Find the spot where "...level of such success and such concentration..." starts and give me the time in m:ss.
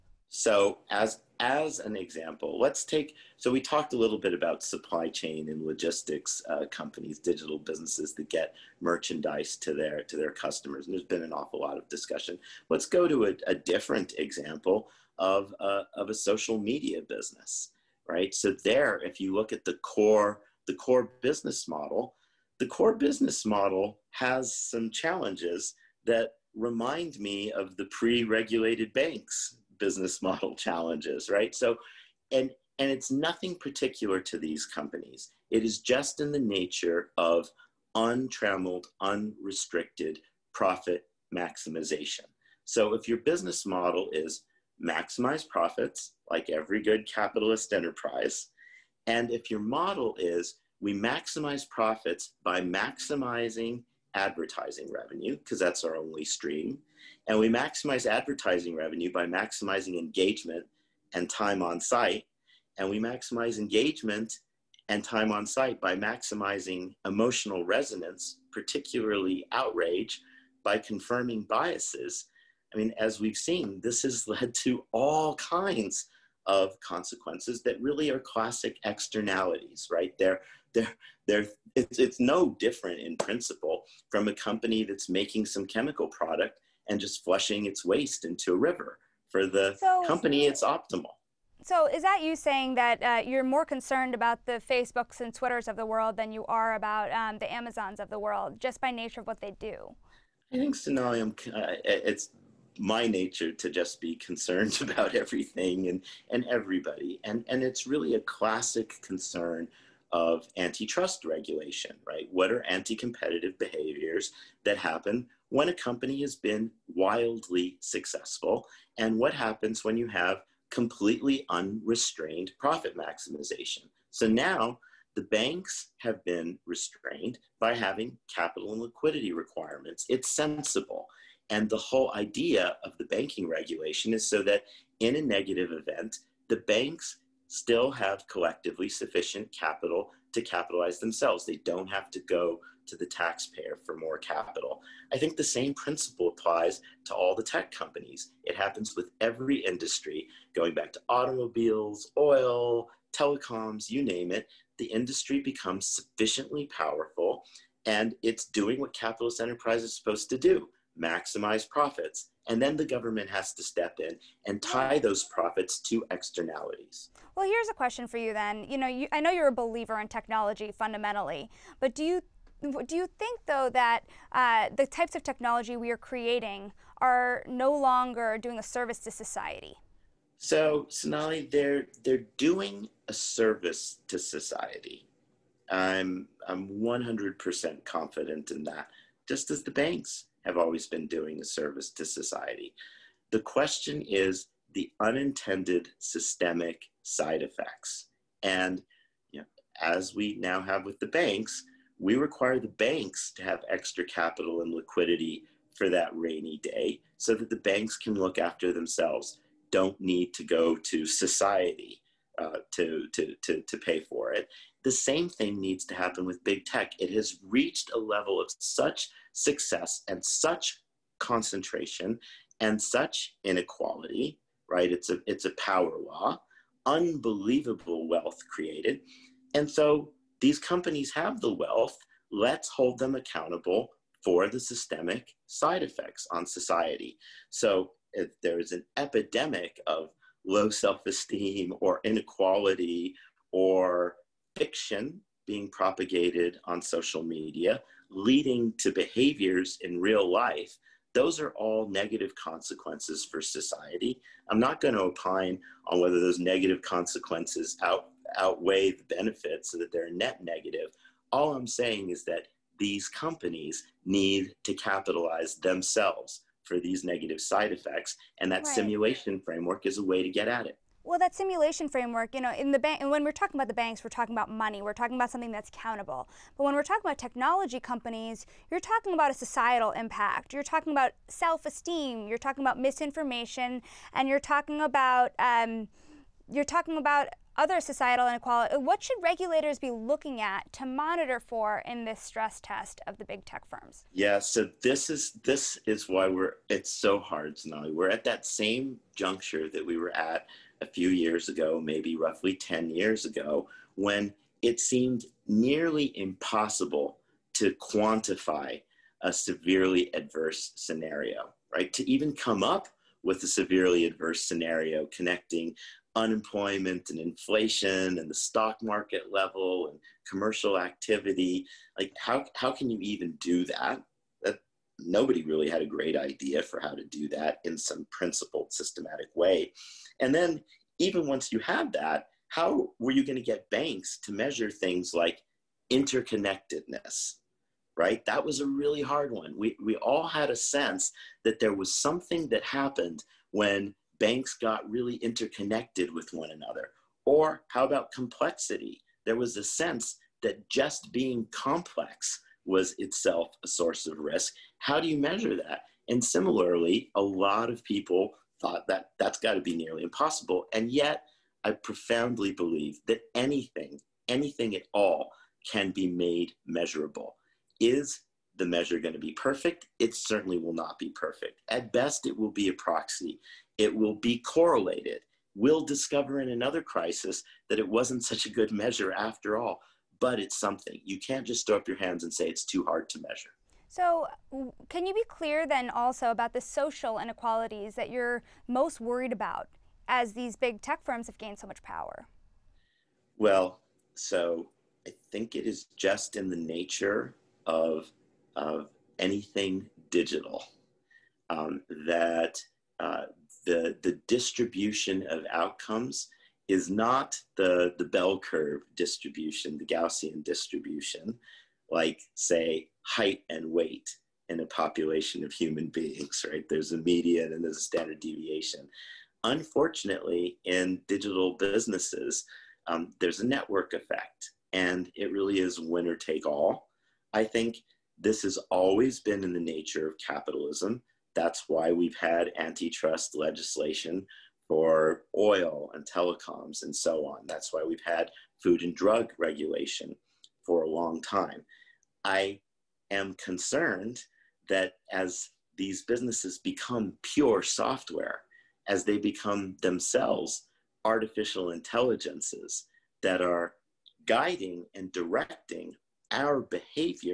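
3:37.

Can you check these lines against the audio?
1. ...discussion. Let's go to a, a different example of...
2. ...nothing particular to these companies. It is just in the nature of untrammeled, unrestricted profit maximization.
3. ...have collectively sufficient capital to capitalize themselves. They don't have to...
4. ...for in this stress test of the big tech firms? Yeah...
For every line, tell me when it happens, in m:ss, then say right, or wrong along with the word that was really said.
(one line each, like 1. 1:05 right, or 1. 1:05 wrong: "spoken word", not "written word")
1. 0:11 right
2. 0:33 right
3. 2:17 right
4. 4:51 right.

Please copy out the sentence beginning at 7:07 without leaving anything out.
I think this has always been in the nature of capitalism.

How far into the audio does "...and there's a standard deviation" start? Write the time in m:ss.
6:57.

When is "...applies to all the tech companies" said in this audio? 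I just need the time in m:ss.
2:26.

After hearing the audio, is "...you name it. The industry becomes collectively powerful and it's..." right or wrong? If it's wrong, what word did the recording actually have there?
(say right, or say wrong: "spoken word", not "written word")
wrong: "sufficiently", not "collectively".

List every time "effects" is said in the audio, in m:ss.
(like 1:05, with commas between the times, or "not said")
3:17, 3:55, 4:27, 7:03.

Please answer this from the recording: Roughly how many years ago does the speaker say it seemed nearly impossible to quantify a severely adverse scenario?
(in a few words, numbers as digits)
10 years.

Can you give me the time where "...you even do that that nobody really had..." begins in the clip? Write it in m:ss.
5:22.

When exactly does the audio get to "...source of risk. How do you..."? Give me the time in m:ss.
5:53.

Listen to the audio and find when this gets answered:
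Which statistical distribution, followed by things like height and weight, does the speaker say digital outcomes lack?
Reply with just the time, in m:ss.
6:49.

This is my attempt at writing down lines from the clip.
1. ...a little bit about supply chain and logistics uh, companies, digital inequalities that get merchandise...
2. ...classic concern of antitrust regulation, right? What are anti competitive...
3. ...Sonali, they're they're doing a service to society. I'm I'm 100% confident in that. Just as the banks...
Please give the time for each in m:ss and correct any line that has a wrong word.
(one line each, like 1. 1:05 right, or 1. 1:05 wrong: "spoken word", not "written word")
1. 0:03 wrong: "businesses", not "inequalities"
2. 1:48 right
3. 3:00 right.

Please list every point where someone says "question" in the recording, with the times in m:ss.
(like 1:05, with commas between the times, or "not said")
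2:47, 3:13.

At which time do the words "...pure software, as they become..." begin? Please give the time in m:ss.
7:27.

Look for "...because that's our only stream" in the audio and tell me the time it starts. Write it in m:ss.
0:55.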